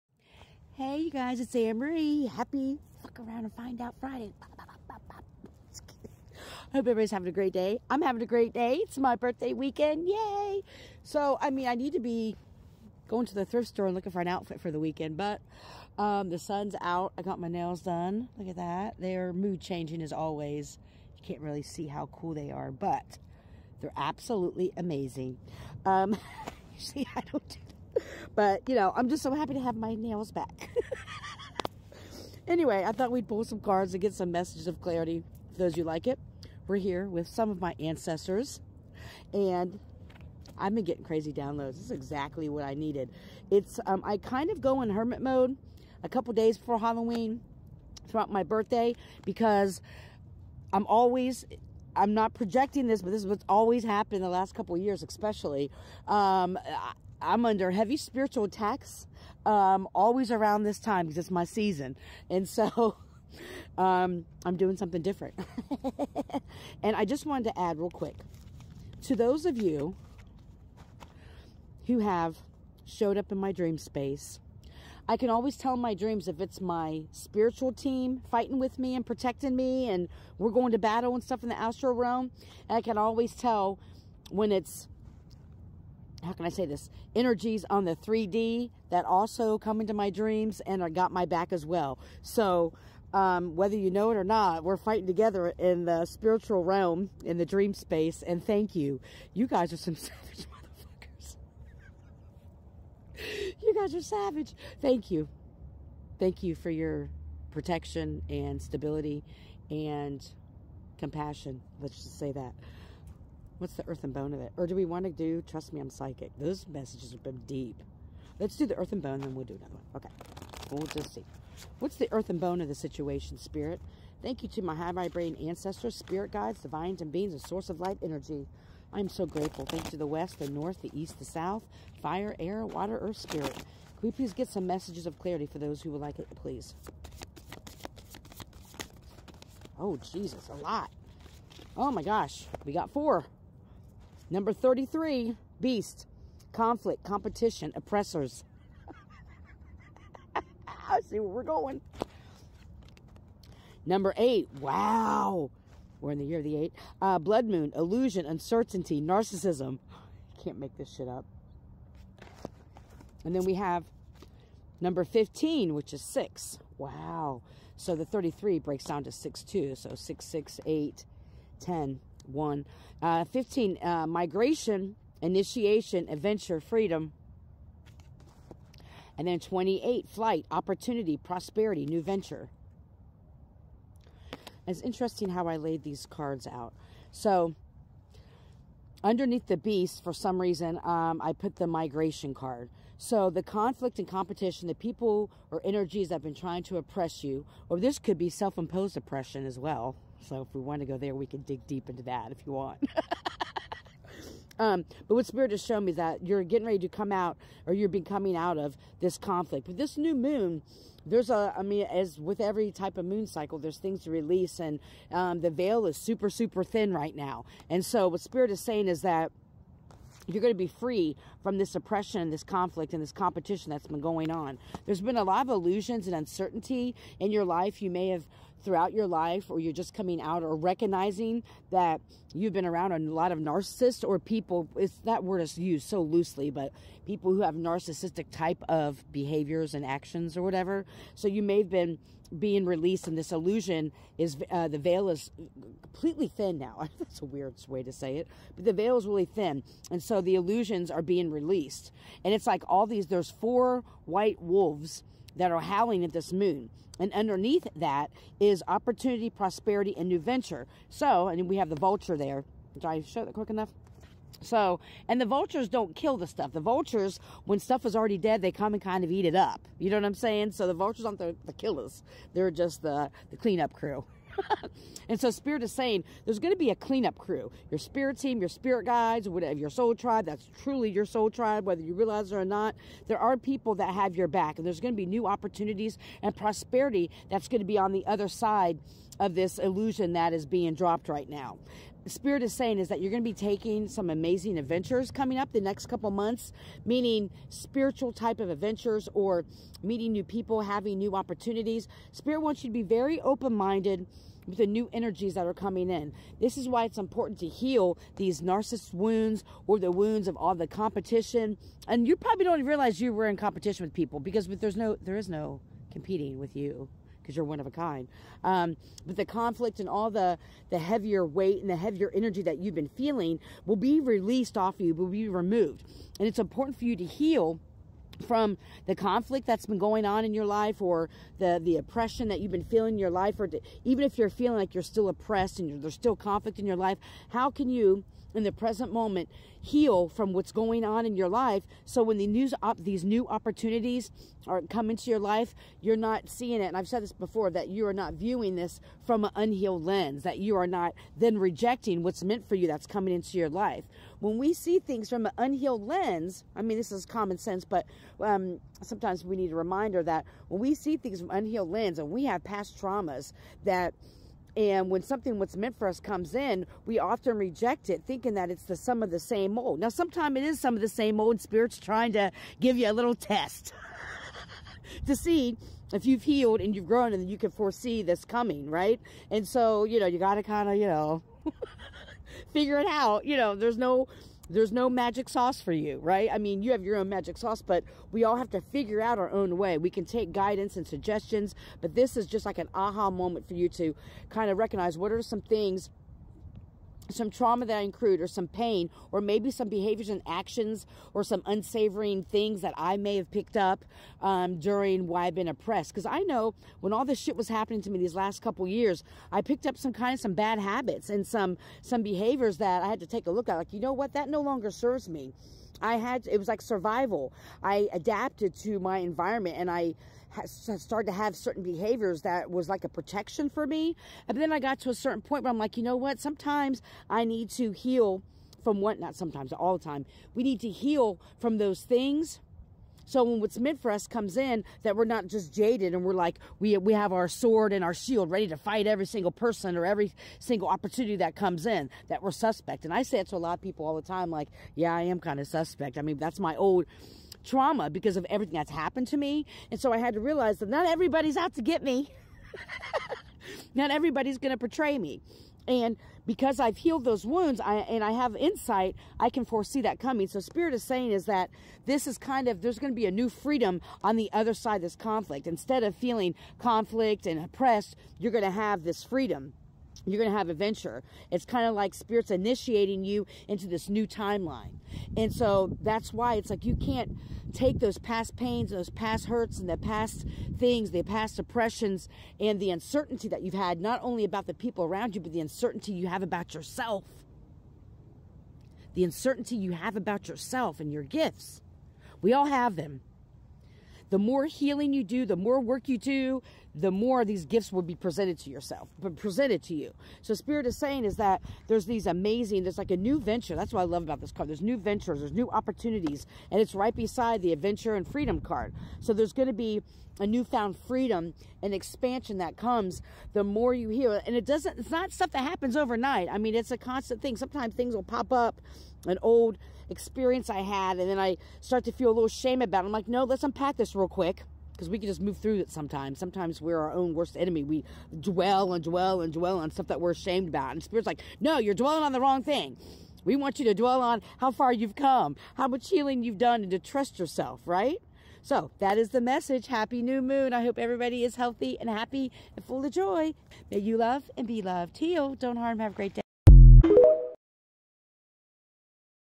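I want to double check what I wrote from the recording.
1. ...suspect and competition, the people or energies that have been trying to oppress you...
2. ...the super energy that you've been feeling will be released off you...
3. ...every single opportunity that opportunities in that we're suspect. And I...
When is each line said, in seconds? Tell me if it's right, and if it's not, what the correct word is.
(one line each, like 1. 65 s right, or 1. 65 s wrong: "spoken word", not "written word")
1. 193 s wrong: "conflict", not "suspect"
2. 321 s wrong: "heavier", not "super"
3. 439 s wrong: "comes", not "opportunities".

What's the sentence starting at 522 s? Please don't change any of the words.
I'm like, no, let's unpack this real quick because we can just move through it sometimes.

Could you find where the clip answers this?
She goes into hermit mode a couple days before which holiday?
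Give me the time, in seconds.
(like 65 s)
46 s.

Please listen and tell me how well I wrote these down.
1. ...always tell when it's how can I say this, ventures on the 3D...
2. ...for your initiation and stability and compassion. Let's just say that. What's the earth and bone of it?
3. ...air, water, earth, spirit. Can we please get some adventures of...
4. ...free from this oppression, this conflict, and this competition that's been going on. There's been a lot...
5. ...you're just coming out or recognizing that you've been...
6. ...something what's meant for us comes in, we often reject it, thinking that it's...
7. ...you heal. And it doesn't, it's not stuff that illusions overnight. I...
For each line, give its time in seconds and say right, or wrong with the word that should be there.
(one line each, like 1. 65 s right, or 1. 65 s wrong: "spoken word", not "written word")
1. 82 s wrong: "energies", not "ventures"
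2. 106 s wrong: "protection", not "initiation"
3. 132 s wrong: "messages", not "adventures"
4. 220 s right
5. 229 s right
6. 365 s right
7. 513 s wrong: "happens", not "illusions".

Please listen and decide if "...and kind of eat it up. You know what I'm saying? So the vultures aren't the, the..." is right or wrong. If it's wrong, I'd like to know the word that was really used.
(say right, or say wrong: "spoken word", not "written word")
right.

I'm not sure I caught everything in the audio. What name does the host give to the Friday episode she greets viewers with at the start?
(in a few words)
Fuck Around and Find Out Friday.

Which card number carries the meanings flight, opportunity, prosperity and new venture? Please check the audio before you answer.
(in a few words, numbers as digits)
28.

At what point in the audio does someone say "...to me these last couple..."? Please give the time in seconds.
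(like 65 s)
407 s.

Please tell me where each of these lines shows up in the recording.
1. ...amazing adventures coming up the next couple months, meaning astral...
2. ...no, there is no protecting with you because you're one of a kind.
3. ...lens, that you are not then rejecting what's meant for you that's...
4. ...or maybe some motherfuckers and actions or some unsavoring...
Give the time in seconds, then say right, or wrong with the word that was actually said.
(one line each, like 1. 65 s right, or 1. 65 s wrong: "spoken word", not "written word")
1. 294 s wrong: "spiritual", not "astral"
2. 314 s wrong: "competing", not "protecting"
3. 349 s right
4. 399 s wrong: "behaviors", not "motherfuckers".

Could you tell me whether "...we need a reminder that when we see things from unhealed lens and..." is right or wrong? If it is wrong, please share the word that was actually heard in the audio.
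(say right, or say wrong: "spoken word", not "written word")
right.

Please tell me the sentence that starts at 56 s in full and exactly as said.
Um, I'm under heavy spiritual attacks, um, always around this time because it's my season.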